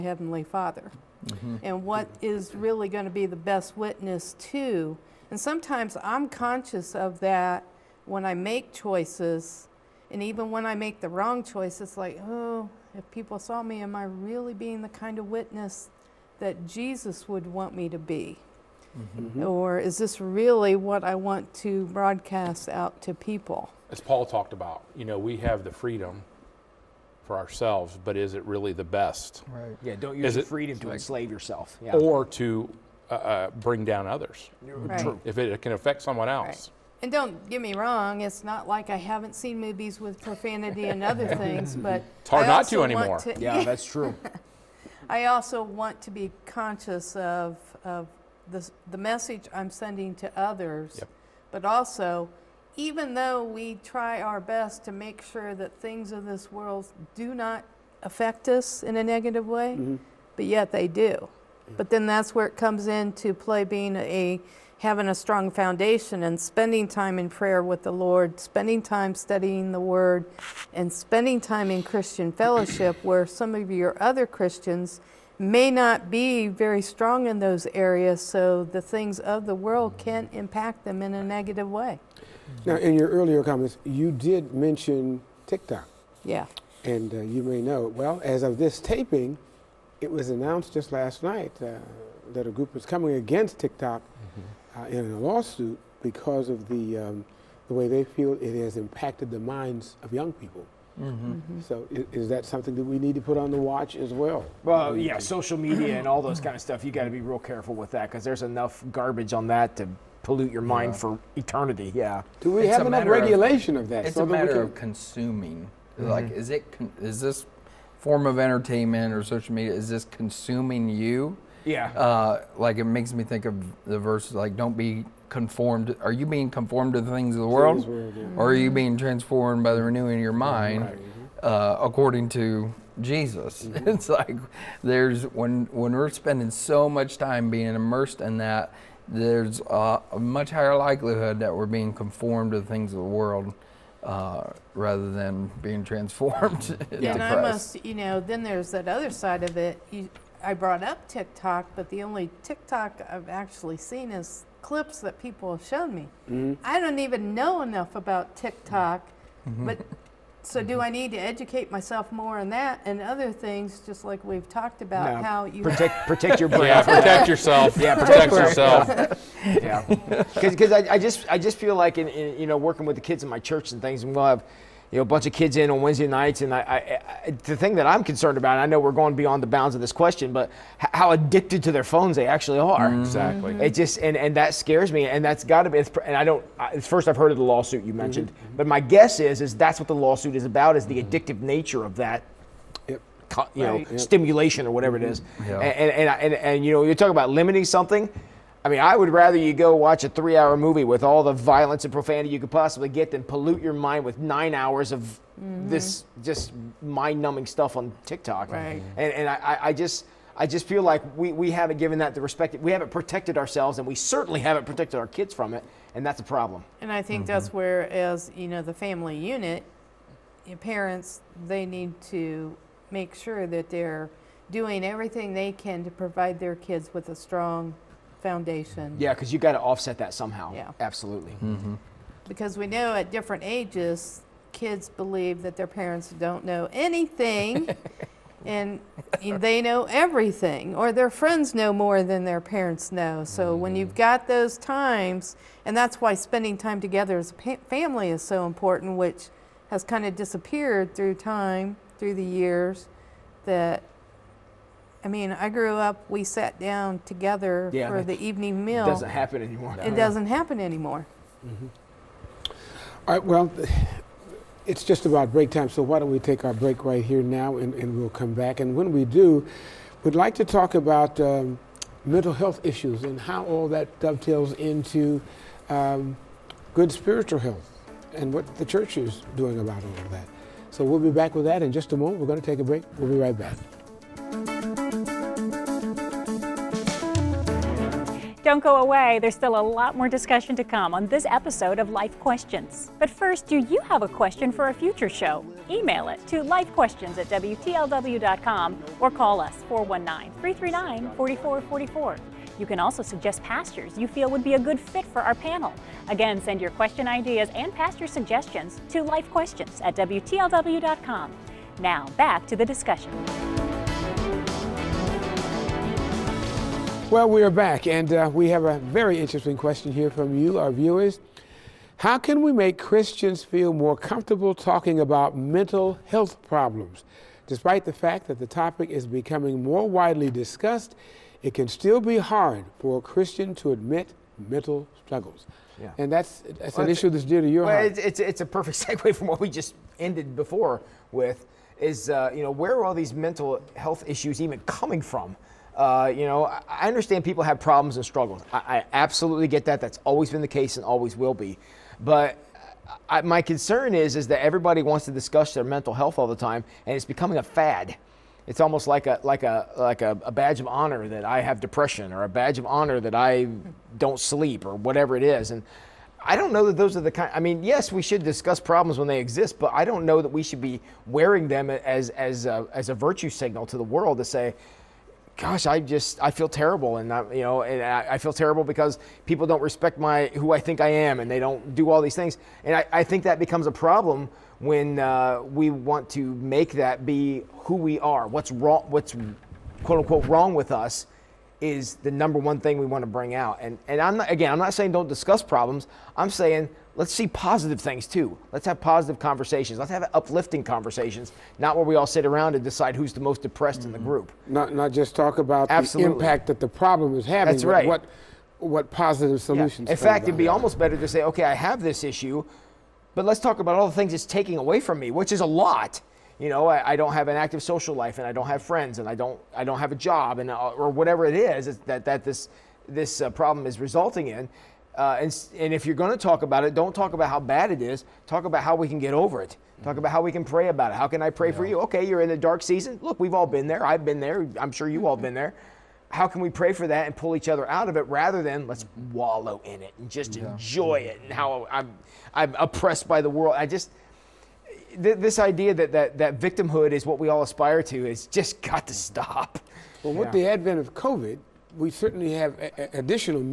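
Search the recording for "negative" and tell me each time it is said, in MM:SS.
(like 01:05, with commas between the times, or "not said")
00:59, 01:21.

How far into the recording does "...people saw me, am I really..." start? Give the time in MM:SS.
00:13.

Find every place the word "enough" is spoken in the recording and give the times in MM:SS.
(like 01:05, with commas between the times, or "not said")
01:48, 01:52, 02:37.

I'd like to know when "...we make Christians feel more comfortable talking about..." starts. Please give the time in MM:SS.
05:22.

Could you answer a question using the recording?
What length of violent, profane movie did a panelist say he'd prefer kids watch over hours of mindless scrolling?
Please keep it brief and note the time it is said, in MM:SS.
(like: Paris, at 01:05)
3 hours, at 03:20.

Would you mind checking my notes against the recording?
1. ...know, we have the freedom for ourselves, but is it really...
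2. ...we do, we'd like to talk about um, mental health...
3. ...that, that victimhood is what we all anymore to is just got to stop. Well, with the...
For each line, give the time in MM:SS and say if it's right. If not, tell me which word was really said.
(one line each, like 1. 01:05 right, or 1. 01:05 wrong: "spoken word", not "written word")
1. 00:25 right
2. 04:28 right
3. 07:25 wrong: "aspire", not "anymore".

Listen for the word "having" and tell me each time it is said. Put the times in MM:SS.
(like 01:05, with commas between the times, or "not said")
01:04, 06:47.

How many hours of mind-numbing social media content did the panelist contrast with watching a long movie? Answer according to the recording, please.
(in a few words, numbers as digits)
9 hours.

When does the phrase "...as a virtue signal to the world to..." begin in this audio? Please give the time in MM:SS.
06:12.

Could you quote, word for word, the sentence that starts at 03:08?
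but my guess is is that's what the lawsuit is about is the mm-hmm.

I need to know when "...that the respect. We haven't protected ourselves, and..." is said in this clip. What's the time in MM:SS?
03:31.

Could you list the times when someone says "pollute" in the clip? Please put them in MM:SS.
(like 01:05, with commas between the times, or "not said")
01:50, 03:23.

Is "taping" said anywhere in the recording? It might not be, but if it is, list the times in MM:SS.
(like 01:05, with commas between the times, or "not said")
01:28.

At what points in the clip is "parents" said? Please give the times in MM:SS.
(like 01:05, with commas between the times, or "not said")
03:40, 03:55, 04:02.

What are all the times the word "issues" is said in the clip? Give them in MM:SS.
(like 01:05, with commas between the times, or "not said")
04:32, 05:36, 05:44, 06:52.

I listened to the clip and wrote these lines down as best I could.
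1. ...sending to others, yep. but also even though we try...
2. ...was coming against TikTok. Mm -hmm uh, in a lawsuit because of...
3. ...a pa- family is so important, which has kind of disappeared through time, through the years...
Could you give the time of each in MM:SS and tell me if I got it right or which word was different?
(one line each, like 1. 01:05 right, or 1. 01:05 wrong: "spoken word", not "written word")
1. 00:49 right
2. 01:32 right
3. 04:07 right.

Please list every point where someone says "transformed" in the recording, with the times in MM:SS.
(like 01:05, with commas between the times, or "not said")
02:08, 02:25.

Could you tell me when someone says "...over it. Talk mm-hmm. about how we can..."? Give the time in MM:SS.
07:09.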